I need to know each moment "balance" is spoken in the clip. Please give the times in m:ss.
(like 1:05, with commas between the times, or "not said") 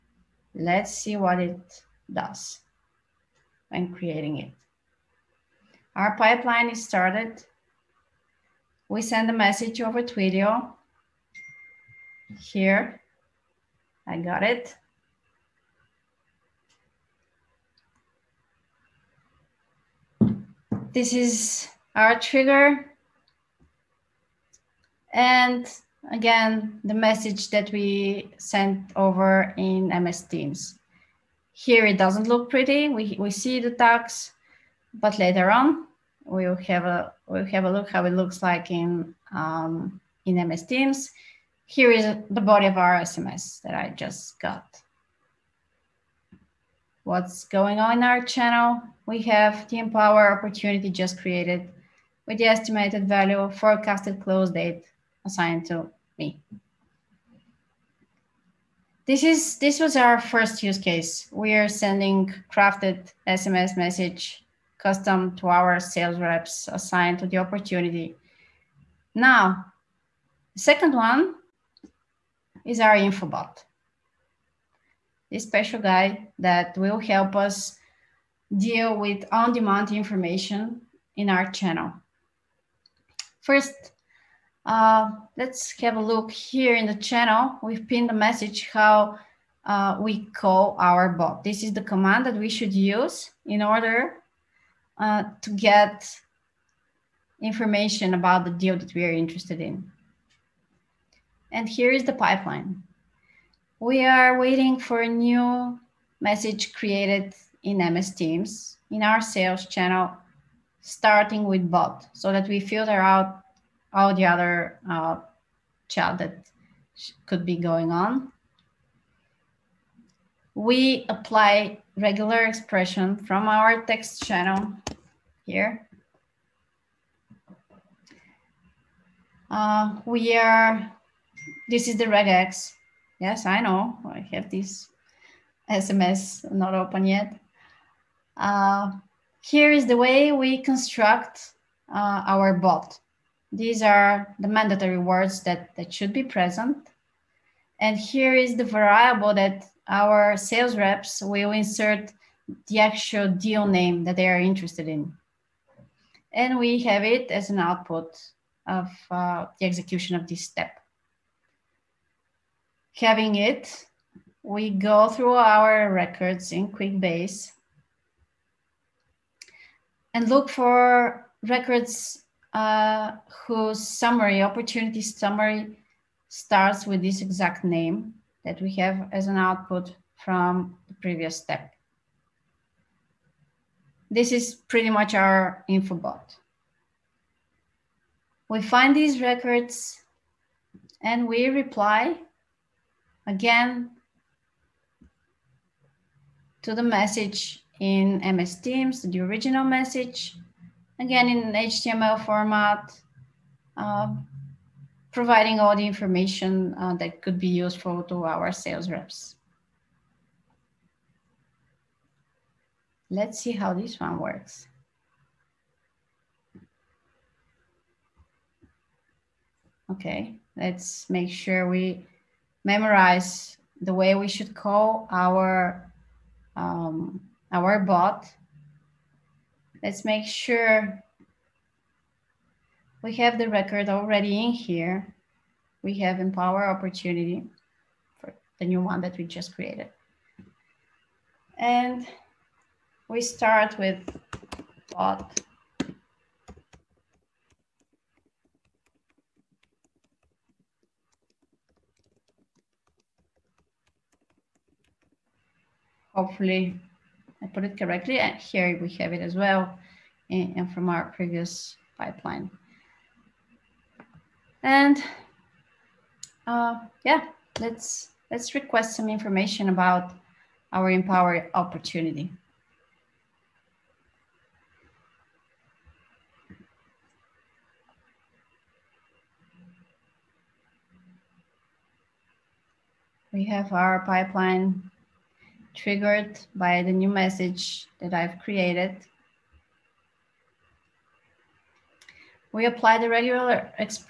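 not said.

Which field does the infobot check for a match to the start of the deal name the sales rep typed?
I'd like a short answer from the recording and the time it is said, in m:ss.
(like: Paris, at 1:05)
opportunity summary, at 2:54.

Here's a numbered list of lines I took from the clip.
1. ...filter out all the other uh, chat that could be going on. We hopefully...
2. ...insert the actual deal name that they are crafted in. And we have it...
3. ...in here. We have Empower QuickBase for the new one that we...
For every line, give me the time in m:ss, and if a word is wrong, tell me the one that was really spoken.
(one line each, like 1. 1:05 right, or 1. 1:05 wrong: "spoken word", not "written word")
1. 1:52 wrong: "apply", not "hopefully"
2. 2:31 wrong: "interested", not "crafted"
3. 3:54 wrong: "Opportunity", not "QuickBase".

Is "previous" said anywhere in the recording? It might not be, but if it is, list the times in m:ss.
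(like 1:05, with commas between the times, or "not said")
3:01, 4:21.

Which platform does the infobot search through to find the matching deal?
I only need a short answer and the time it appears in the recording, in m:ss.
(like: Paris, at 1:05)
QuickBase, at 2:46.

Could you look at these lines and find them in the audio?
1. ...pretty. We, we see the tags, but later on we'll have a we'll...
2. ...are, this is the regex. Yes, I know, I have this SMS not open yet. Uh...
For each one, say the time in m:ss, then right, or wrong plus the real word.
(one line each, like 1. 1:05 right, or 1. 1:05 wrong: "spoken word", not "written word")
1. 0:32 right
2. 2:10 right.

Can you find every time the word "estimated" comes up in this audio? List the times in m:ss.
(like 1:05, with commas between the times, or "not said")
0:52.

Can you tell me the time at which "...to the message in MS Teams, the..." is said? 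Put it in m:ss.
3:16.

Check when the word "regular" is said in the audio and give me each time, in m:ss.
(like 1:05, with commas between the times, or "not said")
2:01, 4:53.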